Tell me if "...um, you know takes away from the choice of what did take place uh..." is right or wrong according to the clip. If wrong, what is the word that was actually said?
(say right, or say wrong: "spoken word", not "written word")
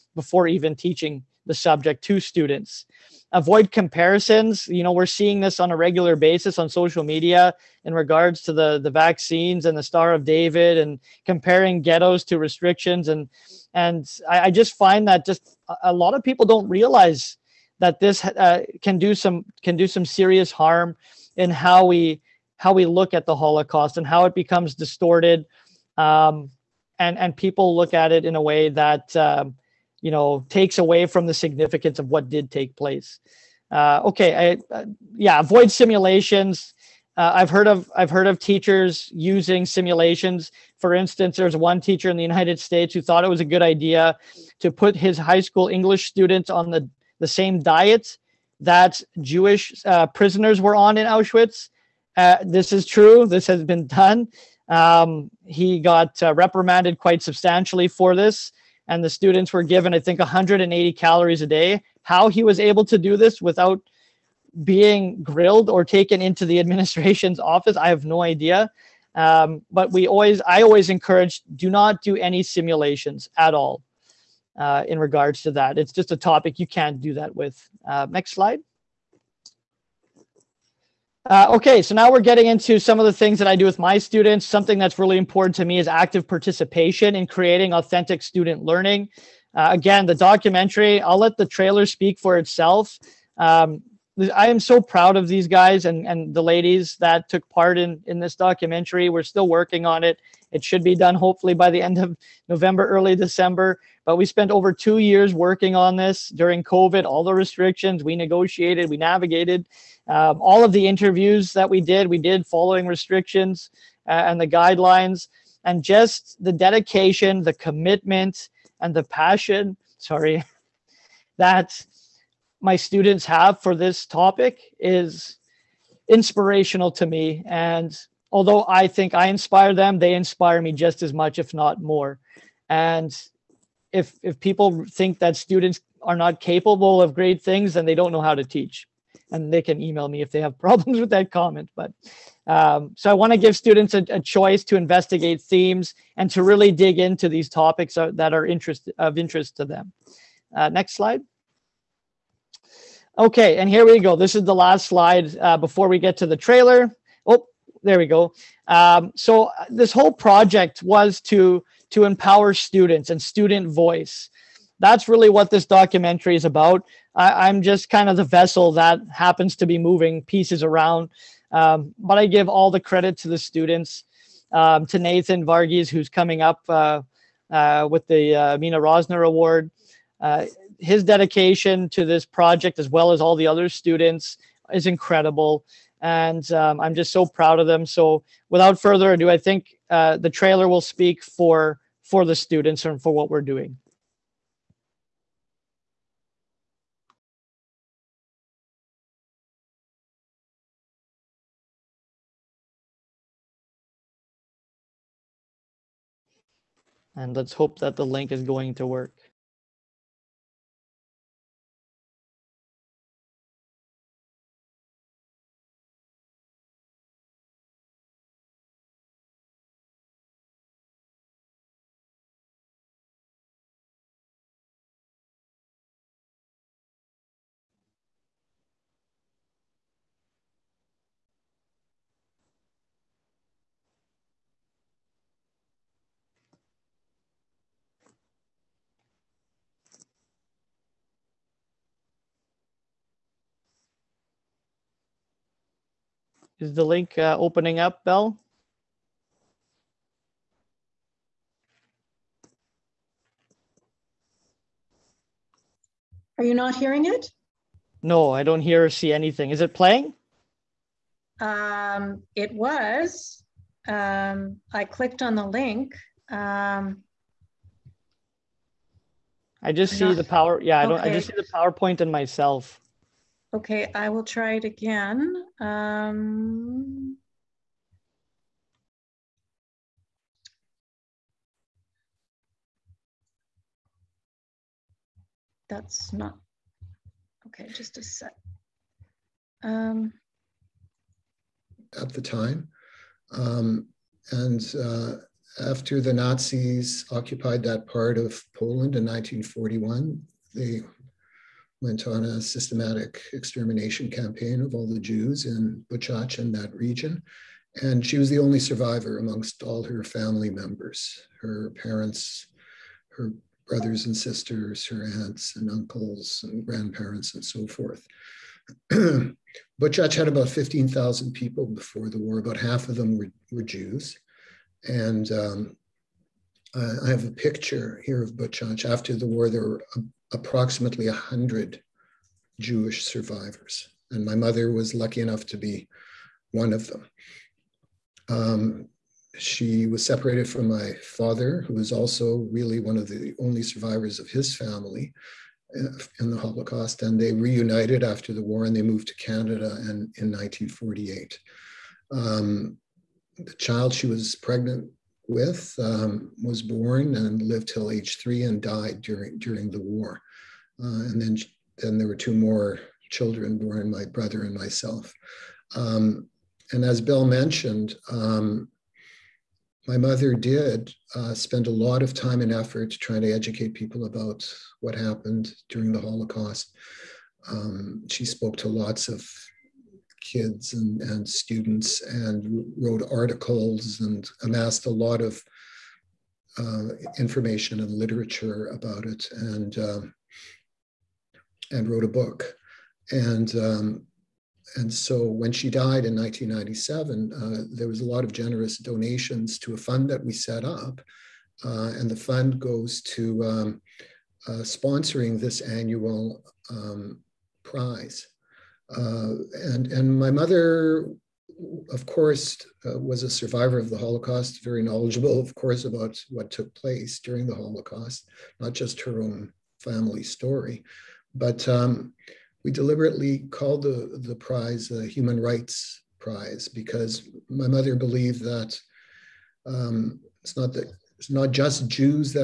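wrong: "significance", not "choice".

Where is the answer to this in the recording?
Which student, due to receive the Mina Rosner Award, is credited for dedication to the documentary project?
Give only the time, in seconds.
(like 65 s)
174 s.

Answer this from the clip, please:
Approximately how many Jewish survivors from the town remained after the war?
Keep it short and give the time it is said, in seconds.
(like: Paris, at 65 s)
100, at 331 s.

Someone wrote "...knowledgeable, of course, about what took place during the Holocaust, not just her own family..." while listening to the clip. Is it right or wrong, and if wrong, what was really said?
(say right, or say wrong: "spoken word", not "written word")
right.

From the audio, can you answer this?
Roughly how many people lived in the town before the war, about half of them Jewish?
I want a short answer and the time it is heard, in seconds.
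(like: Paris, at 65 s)
15,000, at 320 s.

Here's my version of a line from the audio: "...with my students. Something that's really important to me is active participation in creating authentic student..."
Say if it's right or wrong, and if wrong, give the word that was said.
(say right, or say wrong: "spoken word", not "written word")
right.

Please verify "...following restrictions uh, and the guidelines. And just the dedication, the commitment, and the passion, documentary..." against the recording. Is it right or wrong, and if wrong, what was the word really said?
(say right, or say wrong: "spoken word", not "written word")
wrong: "sorry", not "documentary".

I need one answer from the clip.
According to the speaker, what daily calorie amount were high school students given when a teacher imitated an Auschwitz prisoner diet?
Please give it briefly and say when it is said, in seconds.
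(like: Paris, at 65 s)
180, at 60 s.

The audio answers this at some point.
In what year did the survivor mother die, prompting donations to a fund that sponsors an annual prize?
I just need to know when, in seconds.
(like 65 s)
396 s.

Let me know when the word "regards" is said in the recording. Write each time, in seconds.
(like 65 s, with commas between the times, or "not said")
7 s, 74 s.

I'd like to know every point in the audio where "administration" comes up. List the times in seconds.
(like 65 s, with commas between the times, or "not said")
66 s.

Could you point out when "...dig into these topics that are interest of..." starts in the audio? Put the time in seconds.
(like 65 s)
146 s.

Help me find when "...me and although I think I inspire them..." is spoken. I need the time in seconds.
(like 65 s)
127 s.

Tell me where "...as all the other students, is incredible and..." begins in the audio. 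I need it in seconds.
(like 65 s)
183 s.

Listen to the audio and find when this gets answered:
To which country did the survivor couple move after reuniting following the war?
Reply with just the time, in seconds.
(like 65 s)
349 s.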